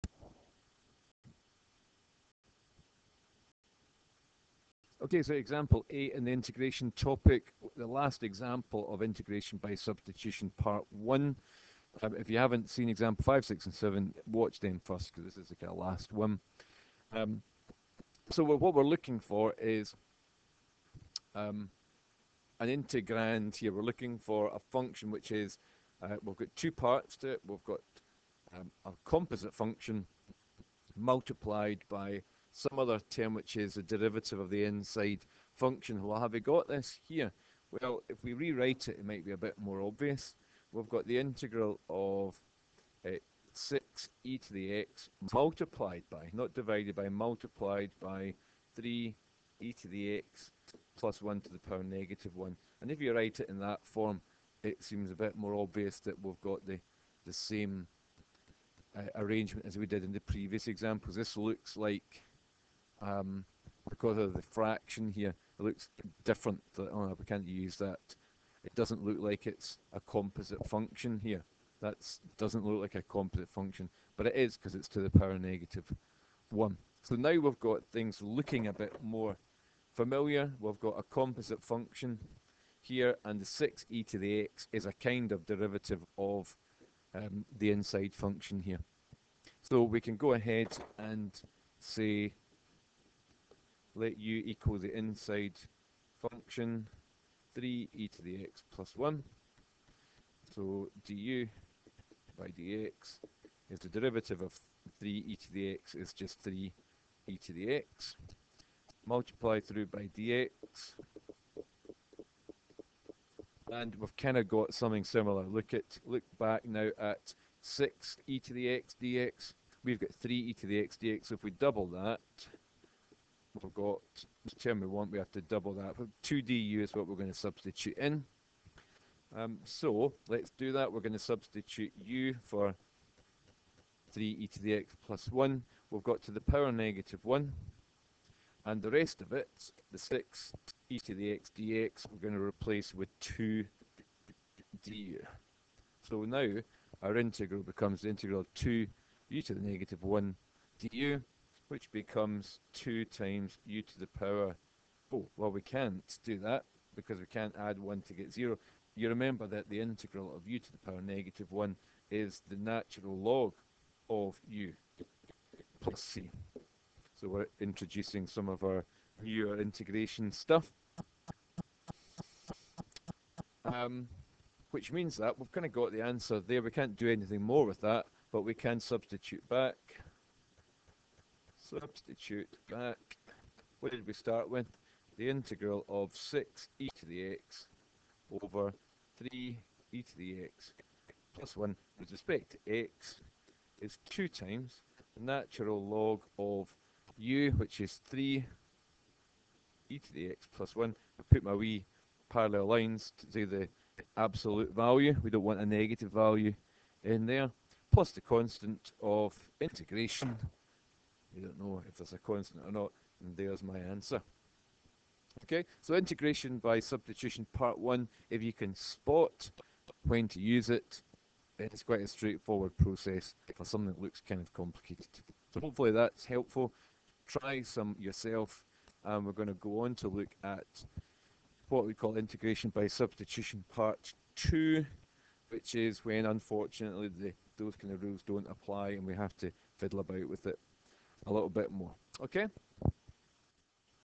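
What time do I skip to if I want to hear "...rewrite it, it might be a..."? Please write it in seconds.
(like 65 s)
38 s.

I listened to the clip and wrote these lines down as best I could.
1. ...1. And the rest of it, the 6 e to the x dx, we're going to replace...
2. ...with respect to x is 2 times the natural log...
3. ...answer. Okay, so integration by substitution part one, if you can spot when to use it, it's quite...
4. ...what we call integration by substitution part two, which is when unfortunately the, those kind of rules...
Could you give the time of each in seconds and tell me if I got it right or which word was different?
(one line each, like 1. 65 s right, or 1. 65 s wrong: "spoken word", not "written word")
1. 137 s right
2. 191 s right
3. 213 s right
4. 231 s right.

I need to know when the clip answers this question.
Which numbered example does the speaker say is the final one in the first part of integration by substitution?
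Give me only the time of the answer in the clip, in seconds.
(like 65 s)
5 s.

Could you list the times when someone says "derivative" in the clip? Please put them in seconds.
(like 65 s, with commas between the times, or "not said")
33 s, 85 s, 103 s.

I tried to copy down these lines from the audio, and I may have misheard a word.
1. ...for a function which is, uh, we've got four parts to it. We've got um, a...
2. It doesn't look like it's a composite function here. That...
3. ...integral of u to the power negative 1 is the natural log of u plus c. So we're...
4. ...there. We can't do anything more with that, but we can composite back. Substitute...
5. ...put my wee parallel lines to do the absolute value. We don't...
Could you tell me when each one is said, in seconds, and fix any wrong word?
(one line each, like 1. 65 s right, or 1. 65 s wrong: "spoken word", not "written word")
1. 24 s wrong: "two", not "four"
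2. 68 s right
3. 159 s right
4. 176 s wrong: "substitute", not "composite"
5. 201 s right.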